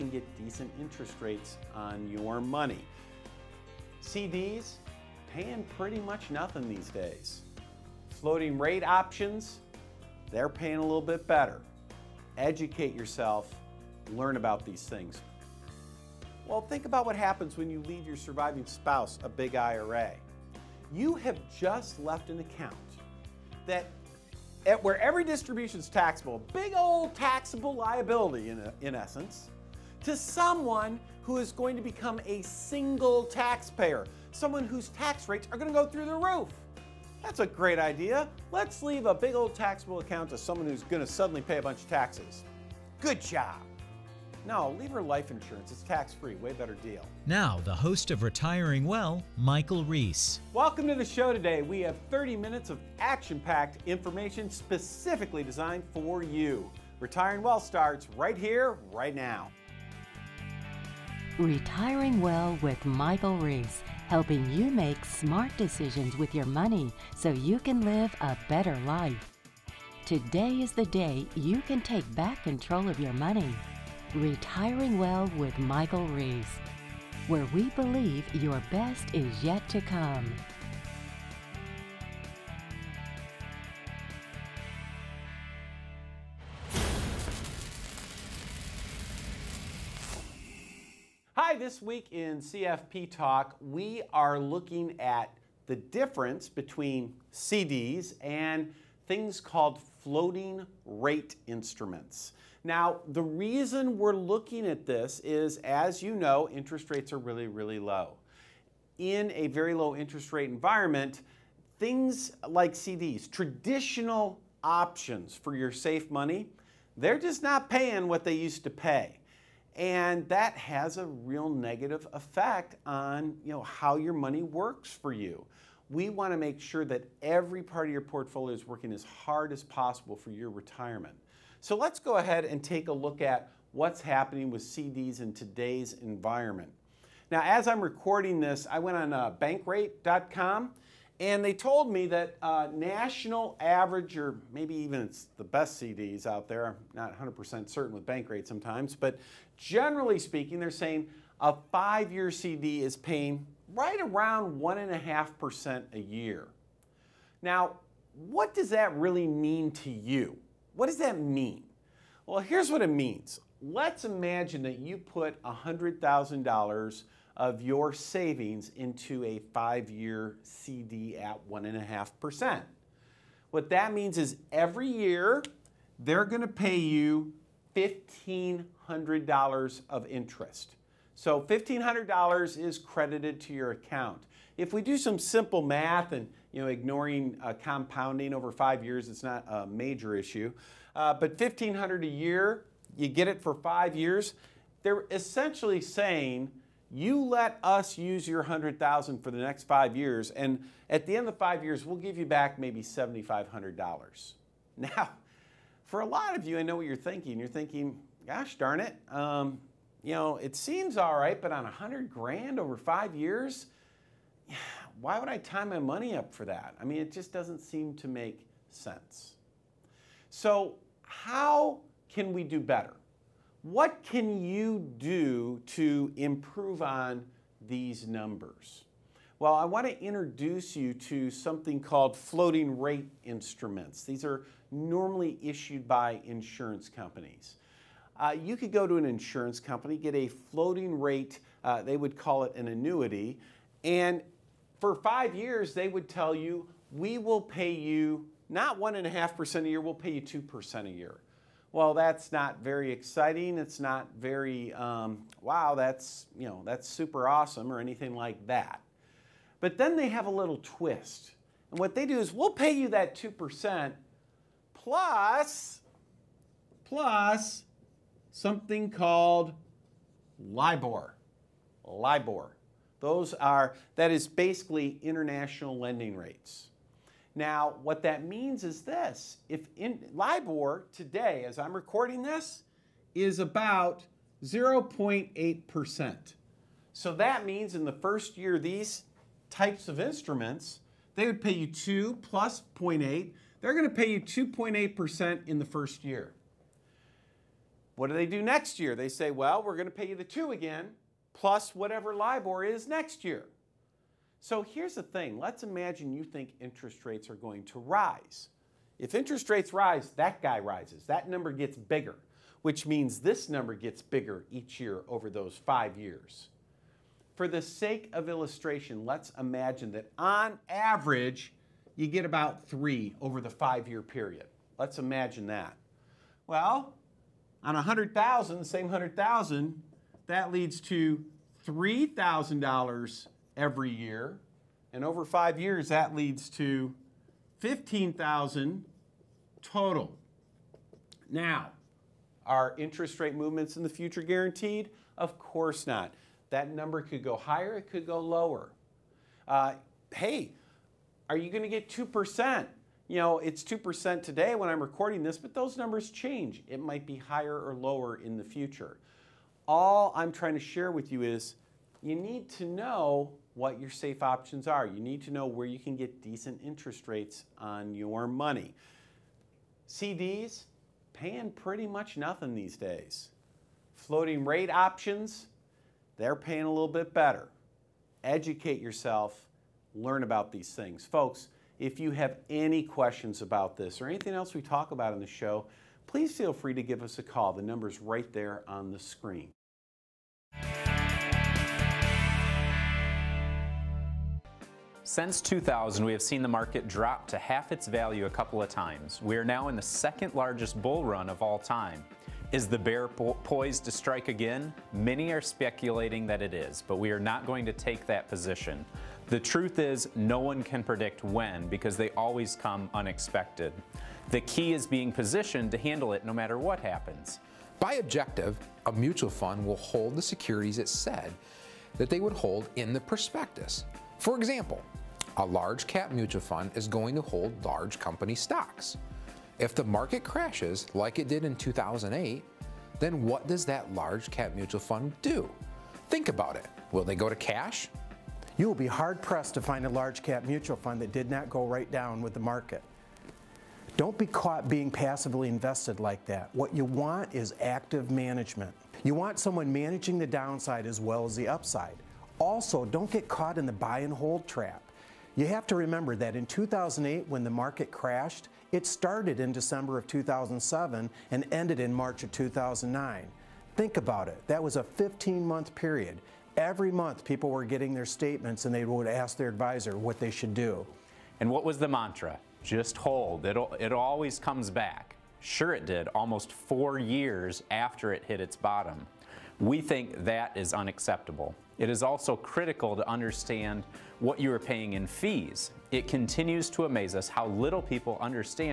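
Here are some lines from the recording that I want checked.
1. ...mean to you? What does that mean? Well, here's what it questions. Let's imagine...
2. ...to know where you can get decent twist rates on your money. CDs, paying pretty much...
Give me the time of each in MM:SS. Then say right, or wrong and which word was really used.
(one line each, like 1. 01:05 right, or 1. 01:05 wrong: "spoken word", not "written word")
1. 02:39 wrong: "means", not "questions"
2. 06:05 wrong: "interest", not "twist".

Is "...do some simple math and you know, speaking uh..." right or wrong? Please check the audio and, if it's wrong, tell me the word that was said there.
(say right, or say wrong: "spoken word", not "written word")
wrong: "ignoring", not "speaking".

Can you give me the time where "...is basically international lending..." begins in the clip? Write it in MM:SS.
04:34.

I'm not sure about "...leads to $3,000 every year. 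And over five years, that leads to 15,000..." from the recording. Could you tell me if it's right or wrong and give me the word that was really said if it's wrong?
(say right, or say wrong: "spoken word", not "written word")
right.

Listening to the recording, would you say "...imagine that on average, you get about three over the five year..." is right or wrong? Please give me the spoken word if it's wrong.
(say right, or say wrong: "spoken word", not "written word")
right.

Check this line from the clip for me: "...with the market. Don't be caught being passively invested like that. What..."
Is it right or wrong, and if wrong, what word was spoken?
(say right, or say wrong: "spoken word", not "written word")
right.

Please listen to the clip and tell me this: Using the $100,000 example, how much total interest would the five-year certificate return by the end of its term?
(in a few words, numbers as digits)
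$7,500.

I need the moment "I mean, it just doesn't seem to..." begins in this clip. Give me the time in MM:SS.
03:36.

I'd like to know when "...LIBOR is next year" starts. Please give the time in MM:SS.
05:02.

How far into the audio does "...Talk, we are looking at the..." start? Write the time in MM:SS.
01:33.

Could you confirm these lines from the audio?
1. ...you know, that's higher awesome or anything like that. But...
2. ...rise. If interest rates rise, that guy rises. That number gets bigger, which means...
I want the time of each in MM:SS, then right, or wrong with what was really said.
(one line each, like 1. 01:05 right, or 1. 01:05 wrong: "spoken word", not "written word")
1. 04:16 wrong: "super", not "higher"
2. 05:07 right.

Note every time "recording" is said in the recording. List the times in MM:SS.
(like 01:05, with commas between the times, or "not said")
02:17, 04:41, 05:54.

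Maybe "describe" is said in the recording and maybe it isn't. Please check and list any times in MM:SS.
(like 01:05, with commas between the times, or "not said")
not said.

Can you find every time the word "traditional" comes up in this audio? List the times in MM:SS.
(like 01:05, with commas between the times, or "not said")
01:53.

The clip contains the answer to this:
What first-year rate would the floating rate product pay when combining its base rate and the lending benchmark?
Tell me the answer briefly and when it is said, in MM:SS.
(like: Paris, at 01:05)
2.8%, at 04:54.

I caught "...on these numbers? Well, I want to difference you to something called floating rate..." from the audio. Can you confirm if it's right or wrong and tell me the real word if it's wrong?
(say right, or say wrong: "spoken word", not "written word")
wrong: "introduce", not "difference".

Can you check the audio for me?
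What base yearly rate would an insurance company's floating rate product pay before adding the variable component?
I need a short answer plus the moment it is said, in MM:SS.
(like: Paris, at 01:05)
2%, at 04:09.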